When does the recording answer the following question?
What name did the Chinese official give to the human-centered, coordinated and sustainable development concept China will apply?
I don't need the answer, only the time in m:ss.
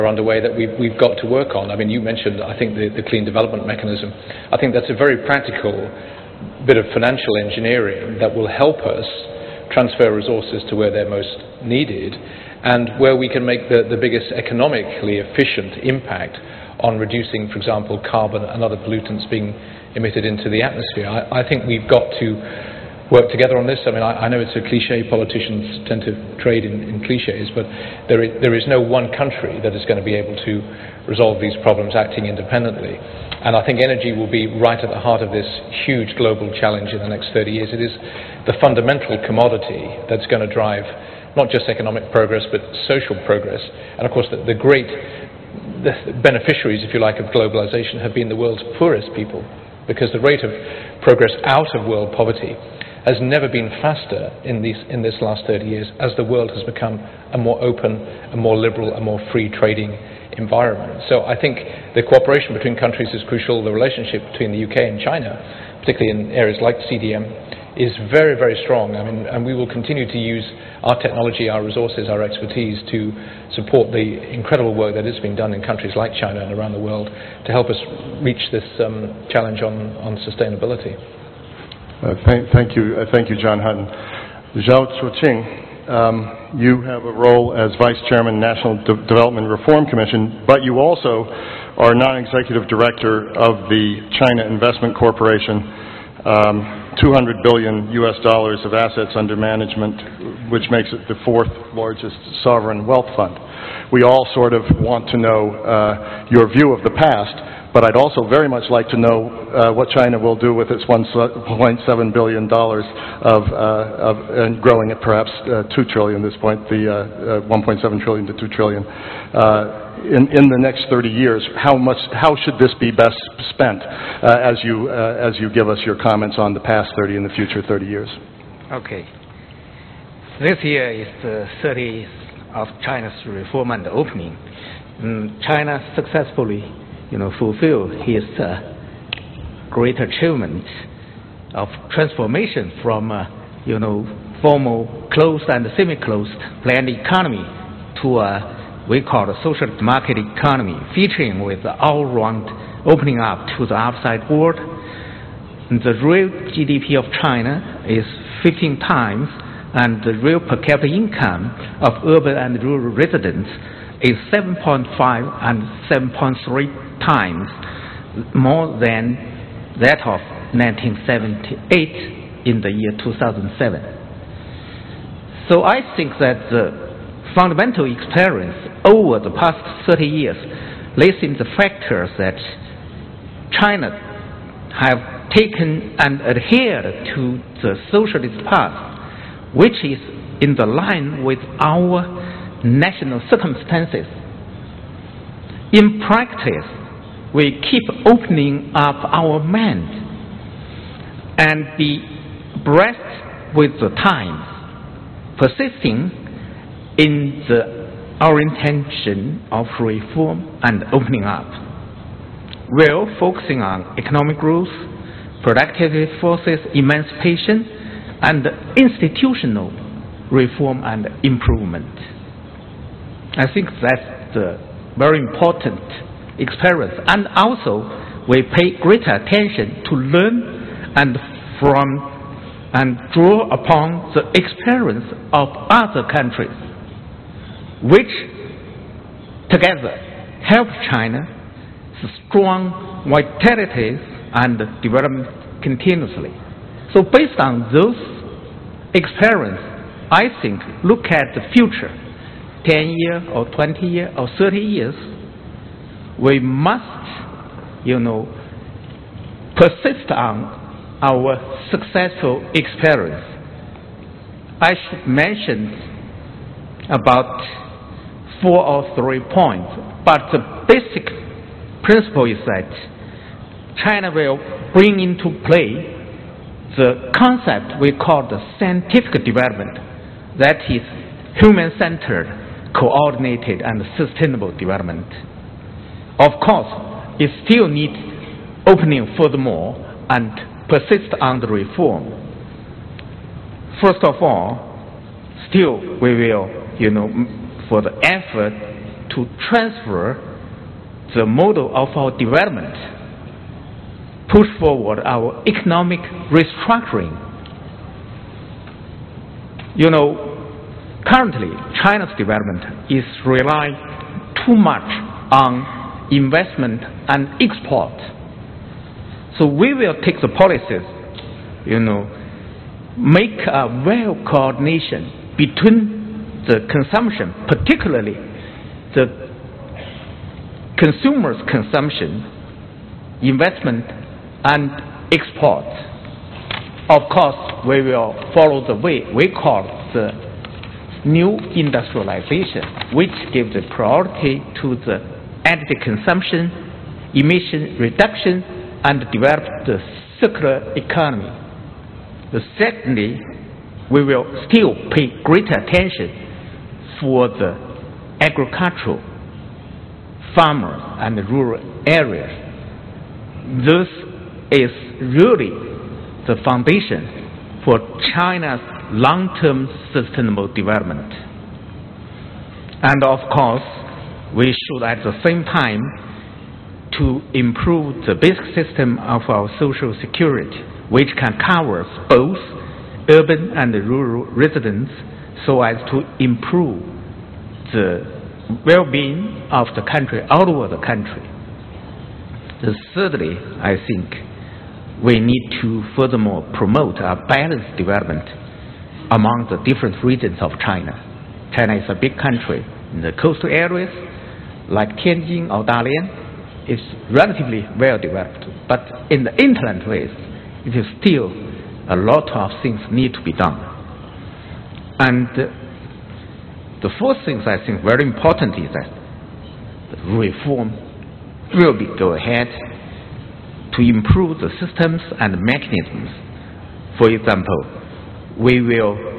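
4:38.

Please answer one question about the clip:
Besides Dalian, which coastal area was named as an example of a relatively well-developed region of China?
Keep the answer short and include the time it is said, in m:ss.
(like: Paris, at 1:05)
Tianjin, at 6:45.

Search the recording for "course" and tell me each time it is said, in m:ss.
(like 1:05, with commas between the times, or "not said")
0:44, 4:46, 5:37, 6:13.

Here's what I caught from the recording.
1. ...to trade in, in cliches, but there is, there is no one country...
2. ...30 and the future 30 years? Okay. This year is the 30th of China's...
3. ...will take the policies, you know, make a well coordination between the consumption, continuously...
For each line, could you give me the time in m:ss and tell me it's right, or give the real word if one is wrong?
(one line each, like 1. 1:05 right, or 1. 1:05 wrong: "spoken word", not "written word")
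1. 0:26 right
2. 2:06 right
3. 5:19 wrong: "particularly", not "continuously".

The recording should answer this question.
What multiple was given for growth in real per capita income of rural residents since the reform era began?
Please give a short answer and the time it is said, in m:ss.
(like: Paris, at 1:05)
7.3 times, at 2:45.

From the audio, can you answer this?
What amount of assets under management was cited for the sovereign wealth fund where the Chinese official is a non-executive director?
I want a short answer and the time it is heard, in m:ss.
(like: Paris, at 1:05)
200 billion U.S. dollars, at 1:37.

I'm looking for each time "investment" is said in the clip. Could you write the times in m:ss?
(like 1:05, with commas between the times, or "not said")
1:34, 5:16, 5:33.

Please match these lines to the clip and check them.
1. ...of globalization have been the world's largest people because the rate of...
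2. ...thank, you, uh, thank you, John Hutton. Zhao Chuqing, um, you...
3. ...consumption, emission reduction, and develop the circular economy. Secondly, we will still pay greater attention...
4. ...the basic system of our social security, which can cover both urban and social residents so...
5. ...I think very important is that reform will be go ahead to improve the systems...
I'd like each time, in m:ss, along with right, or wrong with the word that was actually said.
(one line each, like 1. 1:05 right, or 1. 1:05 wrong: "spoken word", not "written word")
1. 0:47 wrong: "poorest", not "largest"
2. 1:22 right
3. 5:45 right
4. 6:18 wrong: "rural", not "social"
5. 6:57 right.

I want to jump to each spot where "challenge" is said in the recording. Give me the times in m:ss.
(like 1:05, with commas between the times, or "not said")
0:36, 1:19.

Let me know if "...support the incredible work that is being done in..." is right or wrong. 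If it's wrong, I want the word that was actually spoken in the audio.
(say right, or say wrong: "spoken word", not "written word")
right.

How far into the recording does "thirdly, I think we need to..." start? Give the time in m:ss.
6:32.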